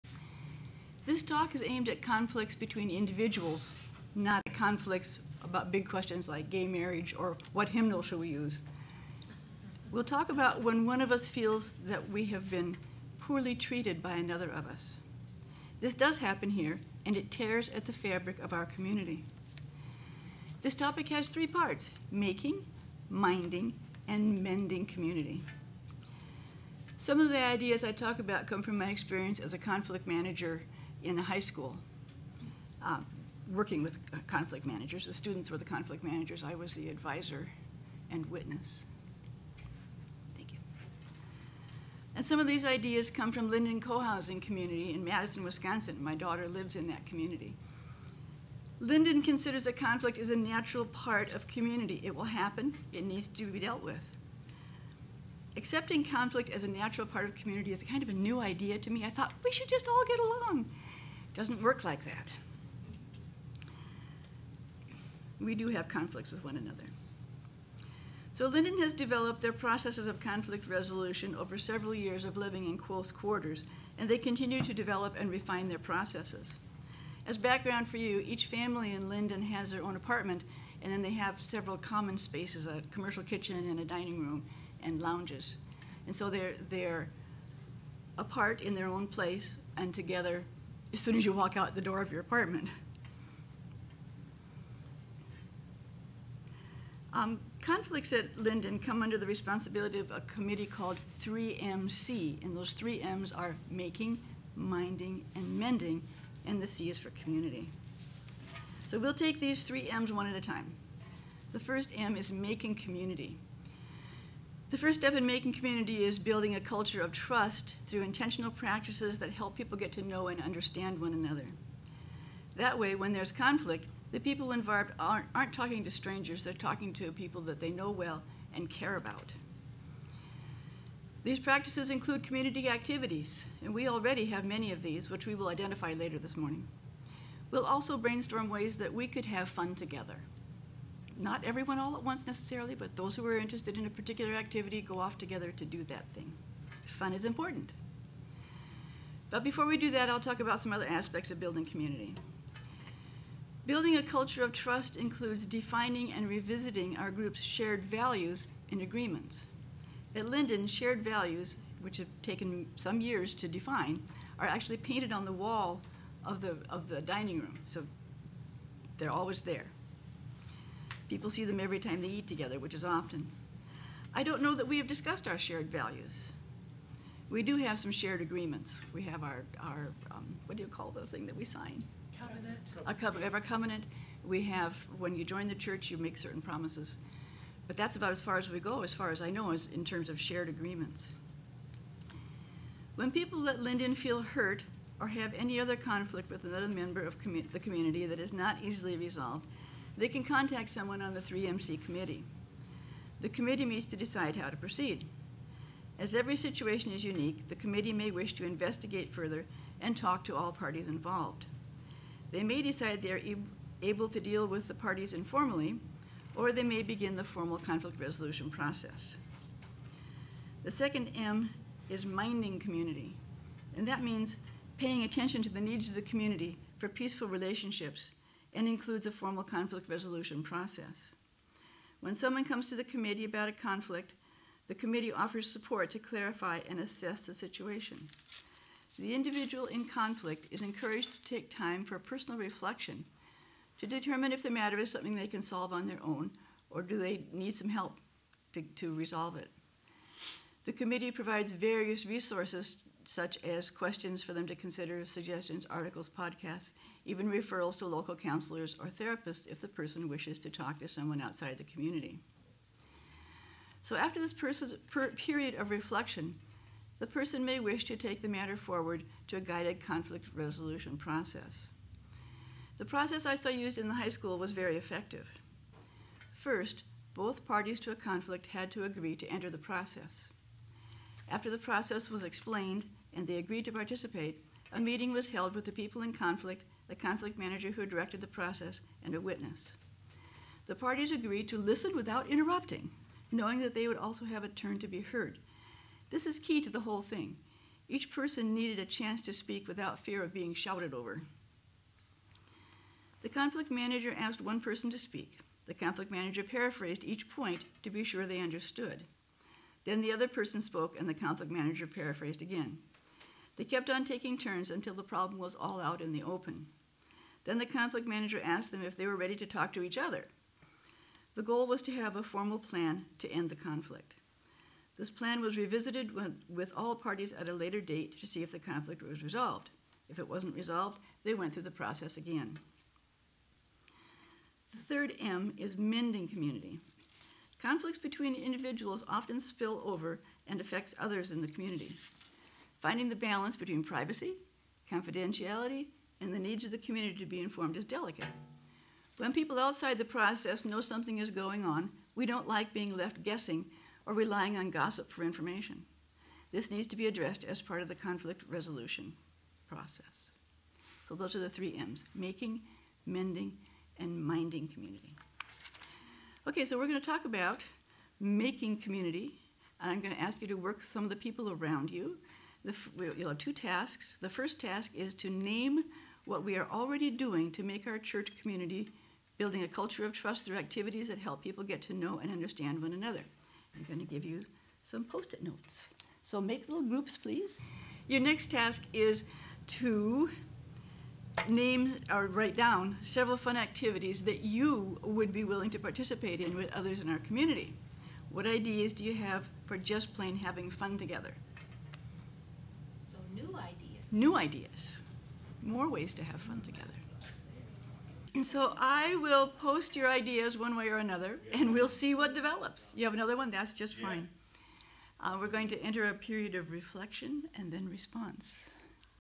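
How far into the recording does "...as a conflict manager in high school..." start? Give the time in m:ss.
0:29.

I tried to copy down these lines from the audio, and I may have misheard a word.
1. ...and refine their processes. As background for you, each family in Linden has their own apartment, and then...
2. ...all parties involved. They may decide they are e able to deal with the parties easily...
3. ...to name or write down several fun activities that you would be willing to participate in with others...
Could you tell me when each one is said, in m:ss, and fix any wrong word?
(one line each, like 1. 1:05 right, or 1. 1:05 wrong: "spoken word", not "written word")
1. 1:15 right
2. 3:30 wrong: "informally", not "easily"
3. 6:29 right.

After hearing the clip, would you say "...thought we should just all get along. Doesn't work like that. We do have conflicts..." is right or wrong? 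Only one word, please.
right.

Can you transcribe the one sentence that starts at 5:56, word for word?
This needs to be addressed as part of the conflict resolution process.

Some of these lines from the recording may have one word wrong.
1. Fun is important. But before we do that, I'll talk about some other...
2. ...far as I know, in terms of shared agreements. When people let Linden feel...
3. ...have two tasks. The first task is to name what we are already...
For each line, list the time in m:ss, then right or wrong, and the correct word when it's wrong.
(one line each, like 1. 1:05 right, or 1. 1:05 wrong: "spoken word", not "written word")
1. 2:26 right
2. 3:08 right
3. 6:13 right.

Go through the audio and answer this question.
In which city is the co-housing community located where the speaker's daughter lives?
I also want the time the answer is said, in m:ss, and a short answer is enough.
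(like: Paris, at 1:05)
Madison, Wisconsin, at 0:45.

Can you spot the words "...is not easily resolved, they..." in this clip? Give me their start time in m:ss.
3:18.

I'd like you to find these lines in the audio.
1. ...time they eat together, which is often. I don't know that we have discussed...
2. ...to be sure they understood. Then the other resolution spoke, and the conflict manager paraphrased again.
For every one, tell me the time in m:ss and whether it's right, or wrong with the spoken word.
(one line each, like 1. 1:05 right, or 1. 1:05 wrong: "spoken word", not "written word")
1. 2:51 right
2. 5:07 wrong: "person", not "resolution".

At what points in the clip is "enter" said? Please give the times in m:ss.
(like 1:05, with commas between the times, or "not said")
4:39, 6:55.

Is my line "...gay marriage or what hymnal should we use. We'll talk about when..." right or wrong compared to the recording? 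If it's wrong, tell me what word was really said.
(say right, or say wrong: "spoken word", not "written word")
right.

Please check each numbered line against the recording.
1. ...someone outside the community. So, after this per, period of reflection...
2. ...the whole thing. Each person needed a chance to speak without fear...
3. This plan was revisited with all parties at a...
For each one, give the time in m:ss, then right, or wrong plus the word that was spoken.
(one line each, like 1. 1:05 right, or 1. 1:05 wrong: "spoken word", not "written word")
1. 4:20 right
2. 4:56 right
3. 5:24 right.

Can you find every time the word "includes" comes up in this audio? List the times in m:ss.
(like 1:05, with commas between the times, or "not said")
2:11, 2:34, 3:48.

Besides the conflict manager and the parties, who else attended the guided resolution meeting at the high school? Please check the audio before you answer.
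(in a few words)
A witness.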